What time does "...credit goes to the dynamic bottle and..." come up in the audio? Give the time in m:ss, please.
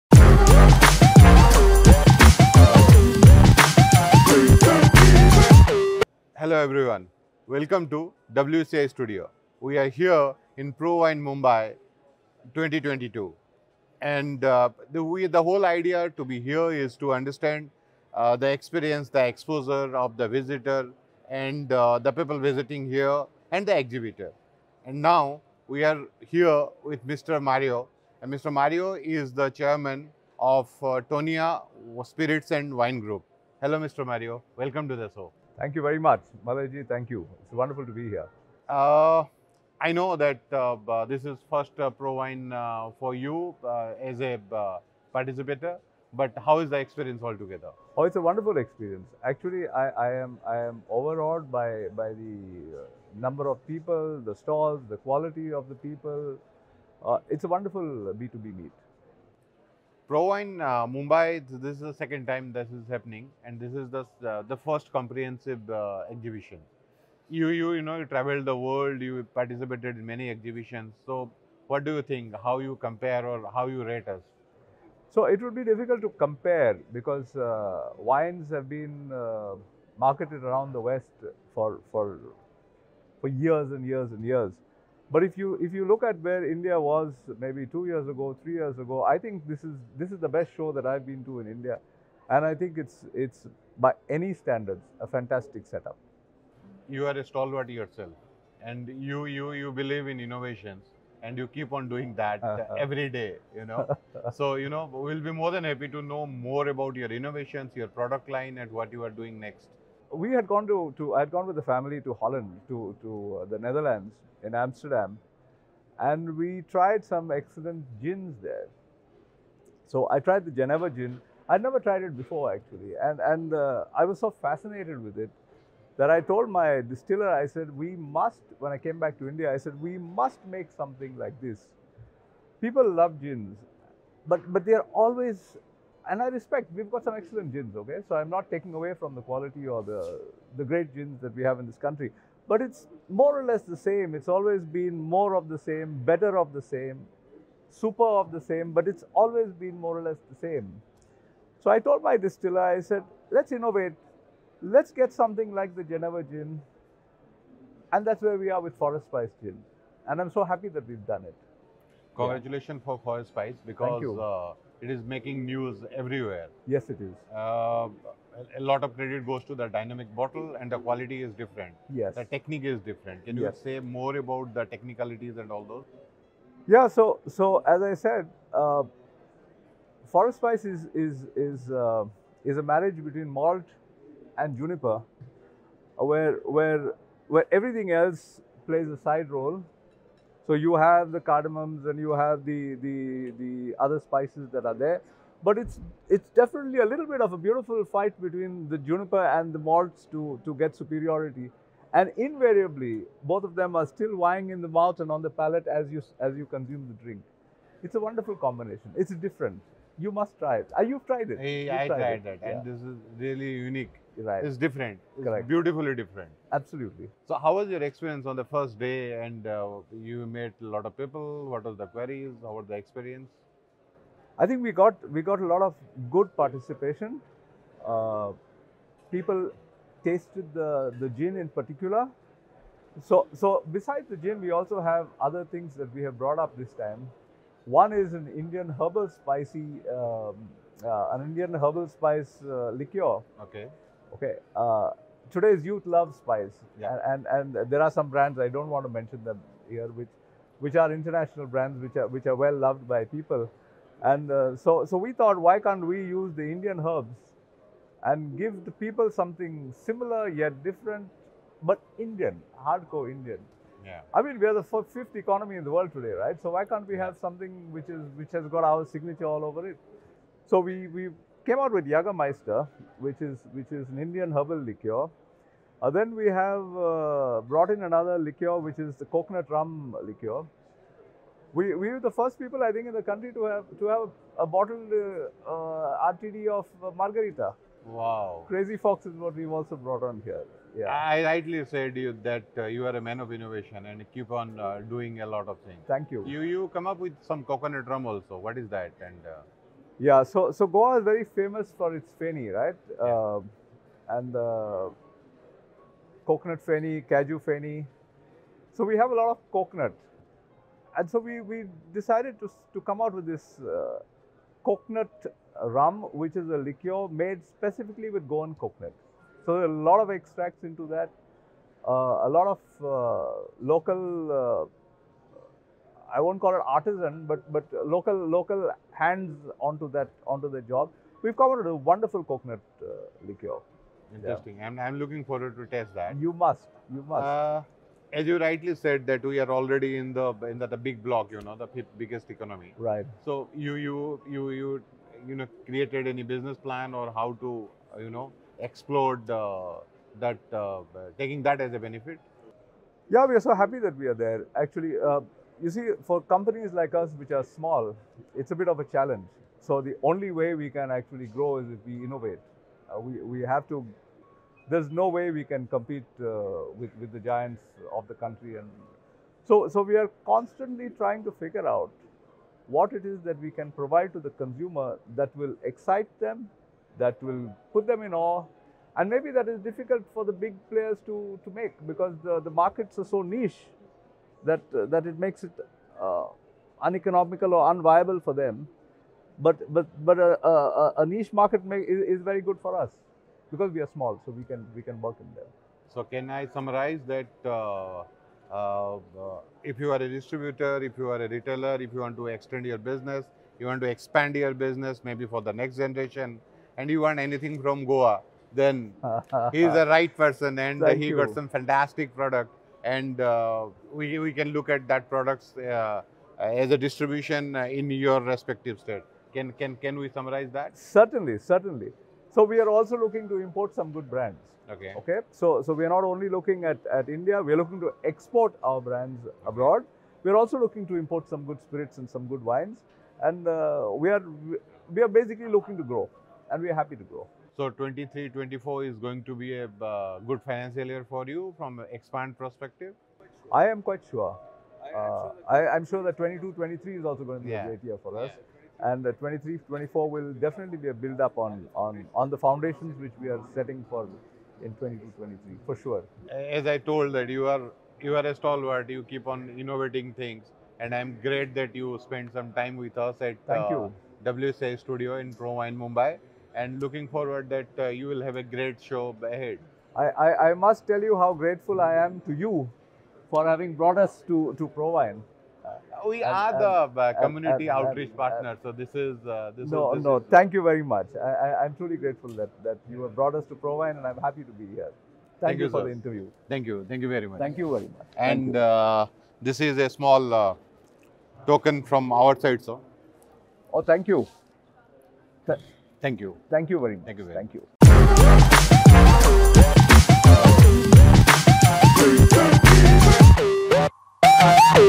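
2:48.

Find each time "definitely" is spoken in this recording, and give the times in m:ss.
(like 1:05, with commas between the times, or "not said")
3:16, 7:30.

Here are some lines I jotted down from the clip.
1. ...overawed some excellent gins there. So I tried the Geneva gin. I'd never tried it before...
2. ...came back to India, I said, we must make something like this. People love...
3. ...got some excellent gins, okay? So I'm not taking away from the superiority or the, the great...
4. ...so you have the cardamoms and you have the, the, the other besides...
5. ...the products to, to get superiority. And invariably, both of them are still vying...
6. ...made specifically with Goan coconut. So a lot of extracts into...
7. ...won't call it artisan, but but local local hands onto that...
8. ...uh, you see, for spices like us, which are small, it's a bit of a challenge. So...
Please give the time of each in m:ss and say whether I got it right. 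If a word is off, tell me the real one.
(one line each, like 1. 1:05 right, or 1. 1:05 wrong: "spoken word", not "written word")
1. 1:56 wrong: "tried", not "overawed"
2. 2:08 right
3. 2:16 wrong: "quality", not "superiority"
4. 3:10 wrong: "spices", not "besides"
5. 3:19 wrong: "malts", not "products"
6. 5:17 right
7. 5:26 right
8. 5:55 wrong: "companies", not "spices".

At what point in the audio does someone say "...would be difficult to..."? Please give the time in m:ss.
1:15.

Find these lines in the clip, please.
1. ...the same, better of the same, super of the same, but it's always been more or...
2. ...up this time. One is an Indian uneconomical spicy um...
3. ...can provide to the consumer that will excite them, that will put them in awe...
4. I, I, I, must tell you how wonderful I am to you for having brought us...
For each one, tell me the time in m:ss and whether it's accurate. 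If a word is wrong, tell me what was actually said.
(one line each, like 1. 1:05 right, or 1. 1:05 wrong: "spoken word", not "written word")
1. 2:25 right
2. 3:56 wrong: "herbal", not "uneconomical"
3. 6:13 right
4. 7:49 wrong: "grateful", not "wonderful".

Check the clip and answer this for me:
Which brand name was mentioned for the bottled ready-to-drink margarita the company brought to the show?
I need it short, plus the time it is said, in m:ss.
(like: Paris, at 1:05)
Crazy Fox, at 4:48.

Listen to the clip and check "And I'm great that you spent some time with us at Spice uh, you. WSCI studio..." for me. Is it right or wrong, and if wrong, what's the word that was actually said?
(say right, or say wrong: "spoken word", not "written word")
wrong: "Thank", not "Spice".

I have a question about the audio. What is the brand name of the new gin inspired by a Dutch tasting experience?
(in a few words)
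Forest Spice Gin.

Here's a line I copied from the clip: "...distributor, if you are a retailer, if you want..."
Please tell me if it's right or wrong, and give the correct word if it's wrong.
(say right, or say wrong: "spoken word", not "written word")
right.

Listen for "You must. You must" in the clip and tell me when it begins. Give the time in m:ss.
5:36.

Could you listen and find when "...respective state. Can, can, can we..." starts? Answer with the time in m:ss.
6:58.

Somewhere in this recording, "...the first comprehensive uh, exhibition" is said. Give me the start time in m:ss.
1:04.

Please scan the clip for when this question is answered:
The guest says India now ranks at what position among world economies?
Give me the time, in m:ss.
4:24.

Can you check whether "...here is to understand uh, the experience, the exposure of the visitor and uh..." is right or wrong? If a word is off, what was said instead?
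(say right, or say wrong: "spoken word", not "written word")
right.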